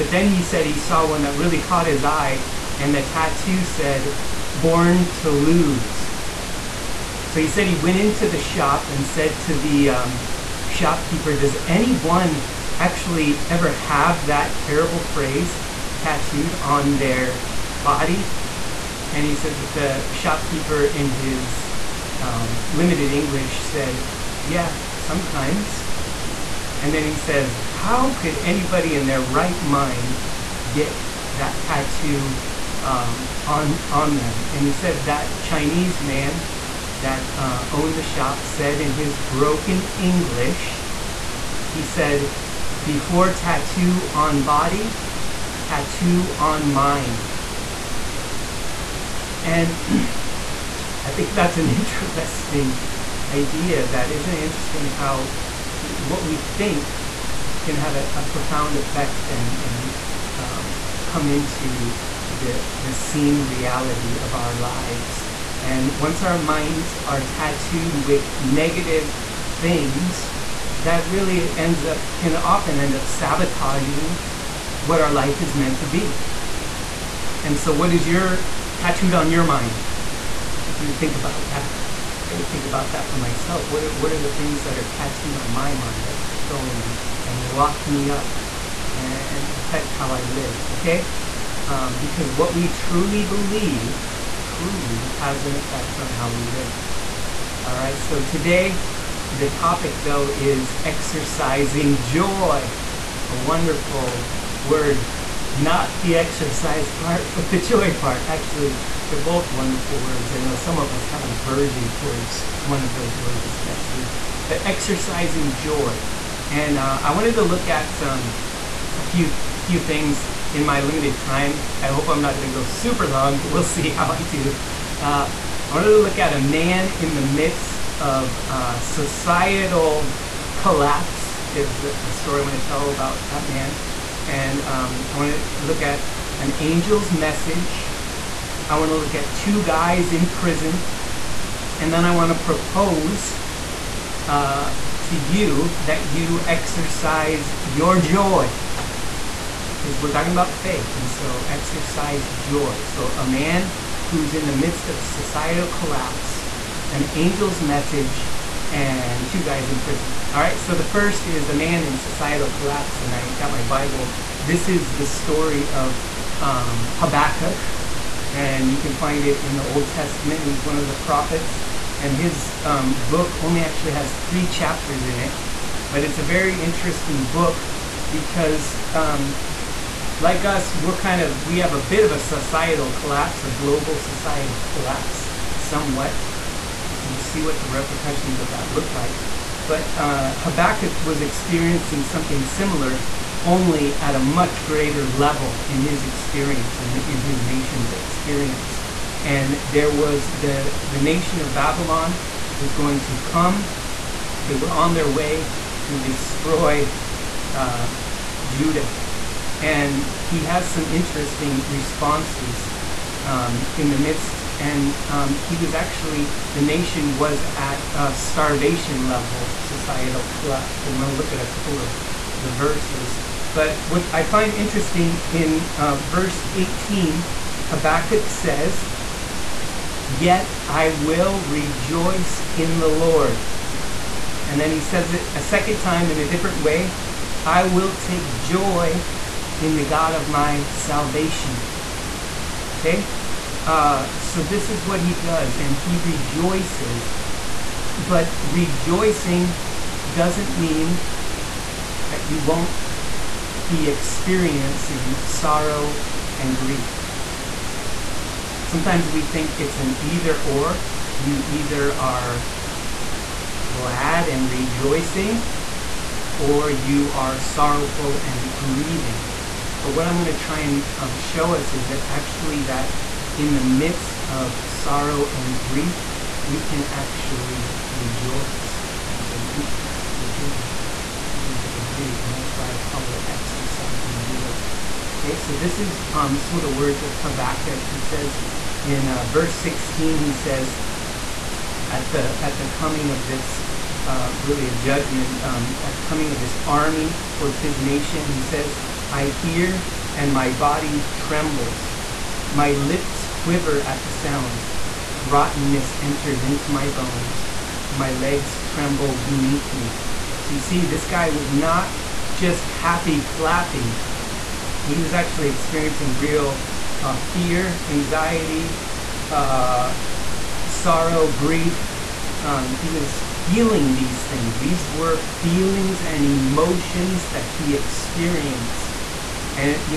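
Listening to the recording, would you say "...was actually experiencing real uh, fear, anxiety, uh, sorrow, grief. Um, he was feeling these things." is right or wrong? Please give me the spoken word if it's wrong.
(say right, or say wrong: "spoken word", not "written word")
right.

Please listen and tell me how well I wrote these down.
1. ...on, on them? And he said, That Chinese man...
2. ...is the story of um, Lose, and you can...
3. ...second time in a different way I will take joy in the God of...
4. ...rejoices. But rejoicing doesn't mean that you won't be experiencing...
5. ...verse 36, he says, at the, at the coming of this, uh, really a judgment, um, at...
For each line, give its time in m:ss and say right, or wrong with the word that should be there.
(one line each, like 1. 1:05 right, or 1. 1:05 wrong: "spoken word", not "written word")
1. 0:33 right
2. 2:44 wrong: "Habakkuk", not "Lose"
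3. 3:55 right
4. 4:05 right
5. 4:49 wrong: "16", not "36".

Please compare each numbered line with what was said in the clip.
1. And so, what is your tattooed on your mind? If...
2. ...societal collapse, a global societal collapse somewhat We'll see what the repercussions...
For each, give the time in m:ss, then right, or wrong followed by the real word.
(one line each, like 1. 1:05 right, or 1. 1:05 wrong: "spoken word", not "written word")
1. 1:17 right
2. 3:02 right.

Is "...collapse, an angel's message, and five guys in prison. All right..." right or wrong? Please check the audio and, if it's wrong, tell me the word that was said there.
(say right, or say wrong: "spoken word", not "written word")
wrong: "two", not "five".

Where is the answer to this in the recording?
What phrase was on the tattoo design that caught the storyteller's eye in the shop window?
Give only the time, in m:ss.
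0:04.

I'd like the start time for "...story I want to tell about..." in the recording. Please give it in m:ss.
2:12.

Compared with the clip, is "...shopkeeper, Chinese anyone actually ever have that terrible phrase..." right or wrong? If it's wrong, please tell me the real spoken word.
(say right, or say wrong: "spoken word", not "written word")
wrong: "Does", not "Chinese".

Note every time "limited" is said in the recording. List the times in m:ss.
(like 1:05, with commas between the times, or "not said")
0:22, 2:00.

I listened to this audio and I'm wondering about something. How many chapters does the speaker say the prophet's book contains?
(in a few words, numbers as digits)
3.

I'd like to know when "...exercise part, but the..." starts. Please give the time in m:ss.
1:46.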